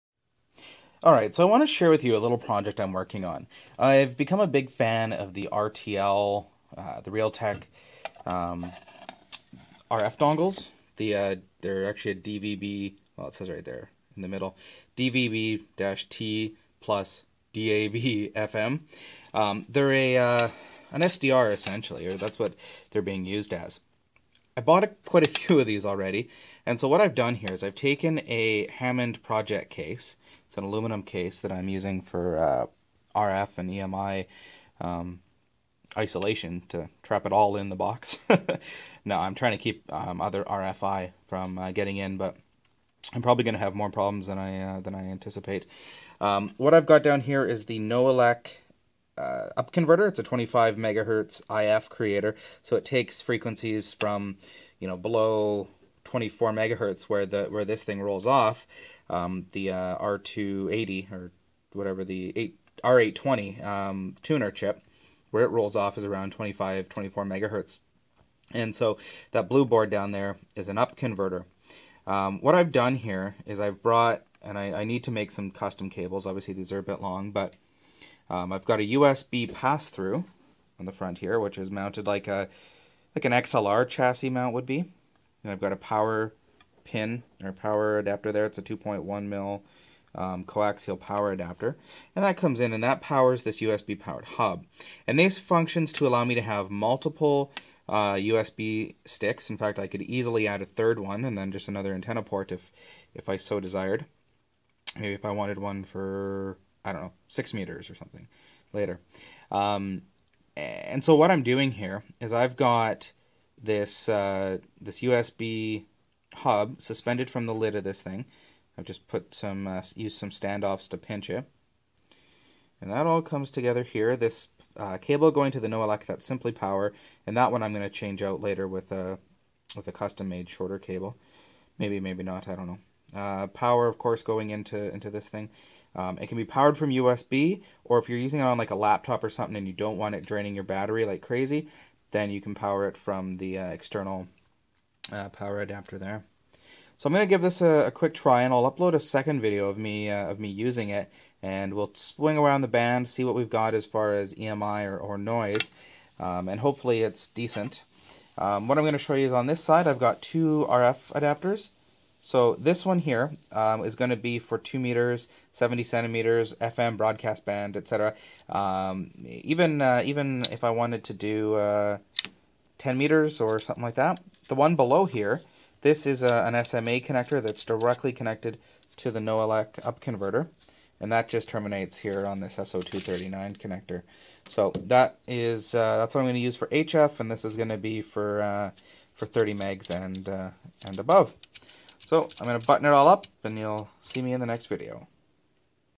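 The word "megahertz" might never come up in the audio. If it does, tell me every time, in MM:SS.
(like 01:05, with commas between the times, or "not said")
00:50, 00:56, 01:07.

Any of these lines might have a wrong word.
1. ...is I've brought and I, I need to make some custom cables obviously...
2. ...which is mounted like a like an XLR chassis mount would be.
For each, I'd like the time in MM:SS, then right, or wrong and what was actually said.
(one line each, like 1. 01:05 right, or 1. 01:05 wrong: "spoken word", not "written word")
1. 01:13 right
2. 01:21 right.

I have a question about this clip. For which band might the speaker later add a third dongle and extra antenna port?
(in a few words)
6 meters.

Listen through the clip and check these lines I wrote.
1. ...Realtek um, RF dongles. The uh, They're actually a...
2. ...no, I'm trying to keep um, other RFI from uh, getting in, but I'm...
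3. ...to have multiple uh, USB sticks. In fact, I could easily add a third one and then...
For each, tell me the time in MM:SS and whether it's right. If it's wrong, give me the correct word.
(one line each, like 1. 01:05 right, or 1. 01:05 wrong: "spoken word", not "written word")
1. 00:07 right
2. 00:39 right
3. 01:36 right.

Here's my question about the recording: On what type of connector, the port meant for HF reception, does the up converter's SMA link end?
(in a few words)
SO239.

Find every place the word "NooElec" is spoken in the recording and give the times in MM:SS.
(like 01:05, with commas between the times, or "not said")
00:47, 02:05, 02:59.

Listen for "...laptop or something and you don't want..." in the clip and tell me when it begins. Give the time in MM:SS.
02:18.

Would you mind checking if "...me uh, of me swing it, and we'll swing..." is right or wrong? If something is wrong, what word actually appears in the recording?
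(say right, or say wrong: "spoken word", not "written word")
wrong: "using", not "swing".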